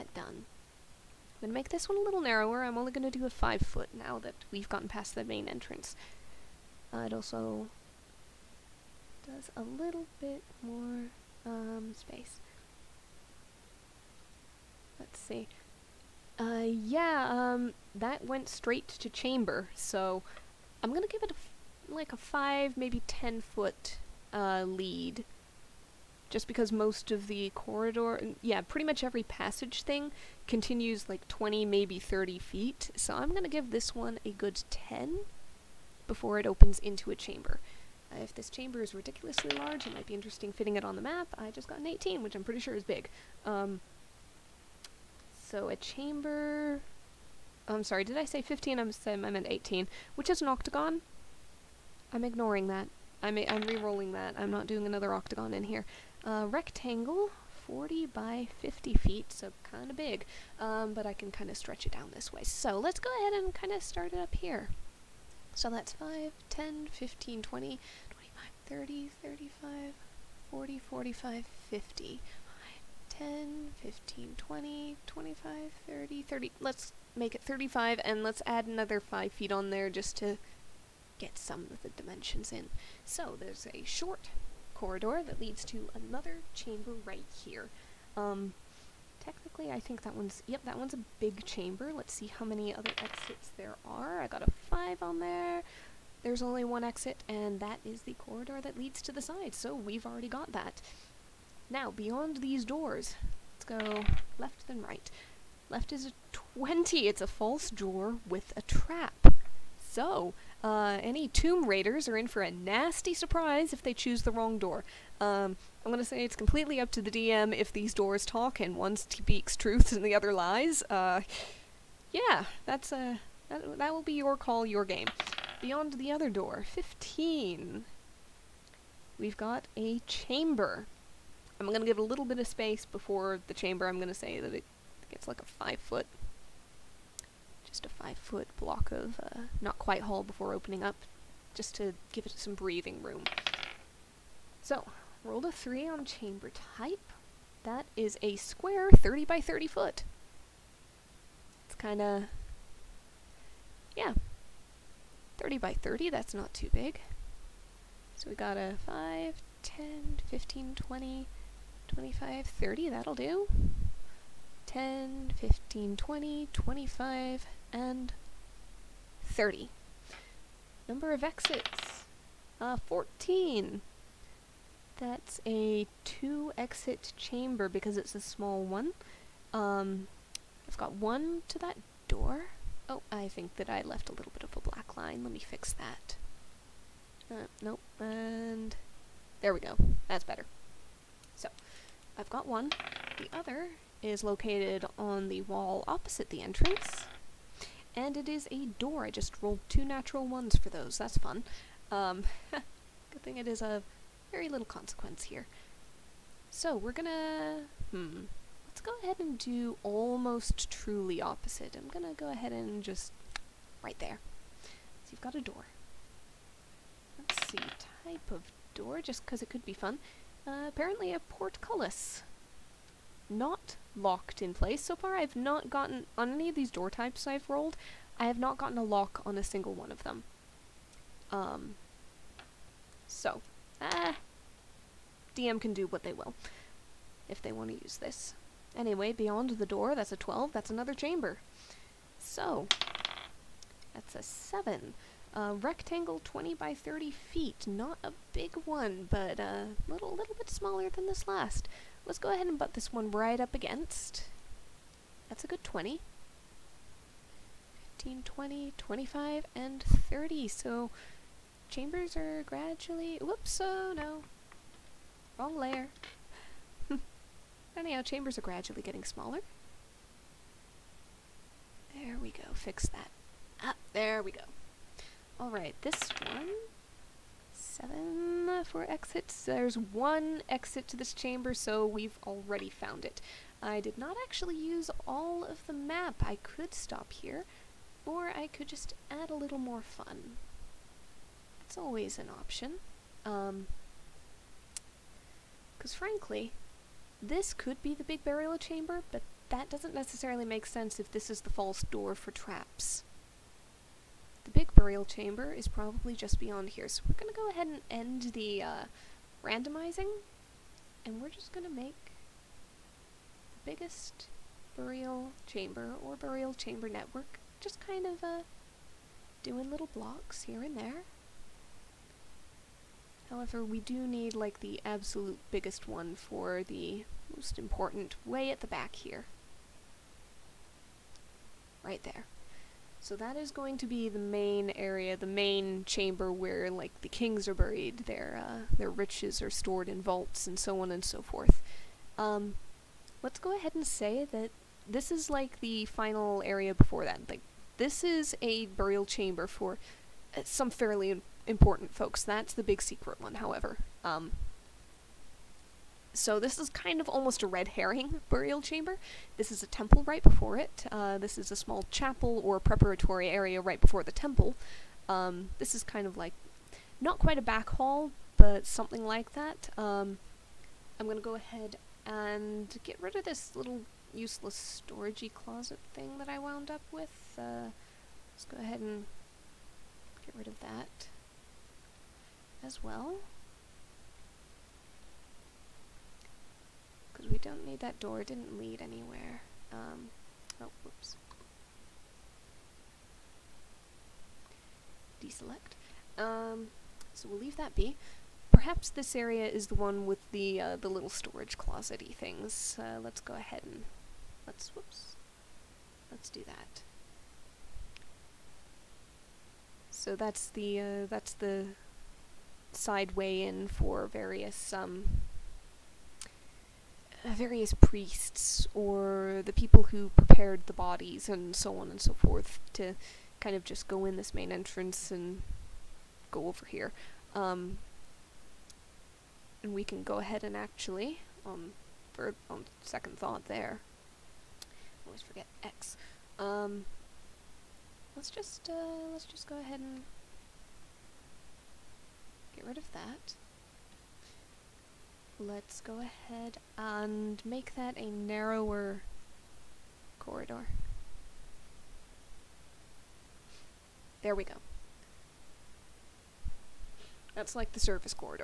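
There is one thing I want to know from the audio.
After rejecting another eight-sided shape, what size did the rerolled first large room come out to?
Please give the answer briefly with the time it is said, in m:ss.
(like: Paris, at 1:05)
40 by 50 feet, at 0:57.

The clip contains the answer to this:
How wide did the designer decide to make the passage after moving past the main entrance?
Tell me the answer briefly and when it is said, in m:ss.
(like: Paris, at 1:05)
5 feet, at 0:03.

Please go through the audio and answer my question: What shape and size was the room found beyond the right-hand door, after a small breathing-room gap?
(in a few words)
Square 30 by 30 foot.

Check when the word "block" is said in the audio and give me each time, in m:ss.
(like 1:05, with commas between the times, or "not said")
2:18, 5:19.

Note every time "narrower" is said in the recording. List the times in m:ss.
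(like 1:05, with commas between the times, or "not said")
0:02, 7:28.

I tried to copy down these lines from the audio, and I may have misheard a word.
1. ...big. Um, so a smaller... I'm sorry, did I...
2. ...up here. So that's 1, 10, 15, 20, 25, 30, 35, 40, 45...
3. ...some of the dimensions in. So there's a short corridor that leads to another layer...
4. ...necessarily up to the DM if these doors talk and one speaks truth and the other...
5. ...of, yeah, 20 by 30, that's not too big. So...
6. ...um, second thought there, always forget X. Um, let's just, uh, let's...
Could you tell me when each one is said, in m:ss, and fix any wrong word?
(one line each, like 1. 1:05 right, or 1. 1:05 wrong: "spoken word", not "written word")
1. 0:42 wrong: "chamber", not "smaller"
2. 1:04 wrong: "5", not "1"
3. 1:21 wrong: "chamber", not "layer"
4. 1:56 wrong: "completely", not "necessarily"
5. 2:32 wrong: "30", not "20"
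6. 7:12 right.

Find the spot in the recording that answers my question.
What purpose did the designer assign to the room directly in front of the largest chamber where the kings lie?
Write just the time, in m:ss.
5:59.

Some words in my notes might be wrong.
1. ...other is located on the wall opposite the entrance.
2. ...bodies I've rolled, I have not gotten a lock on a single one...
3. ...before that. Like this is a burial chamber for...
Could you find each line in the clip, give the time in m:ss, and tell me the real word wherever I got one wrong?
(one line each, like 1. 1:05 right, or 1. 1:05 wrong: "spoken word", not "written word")
1. 3:13 right
2. 3:46 wrong: "types", not "bodies"
3. 5:46 right.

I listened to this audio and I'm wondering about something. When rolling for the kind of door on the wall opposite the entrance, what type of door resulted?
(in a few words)
A portcullis.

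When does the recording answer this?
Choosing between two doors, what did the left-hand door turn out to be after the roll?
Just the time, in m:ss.
1:47.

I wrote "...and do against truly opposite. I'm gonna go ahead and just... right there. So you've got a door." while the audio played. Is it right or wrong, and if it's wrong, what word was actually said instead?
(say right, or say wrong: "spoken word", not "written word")
wrong: "almost", not "against".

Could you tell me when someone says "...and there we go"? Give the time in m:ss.
3:07.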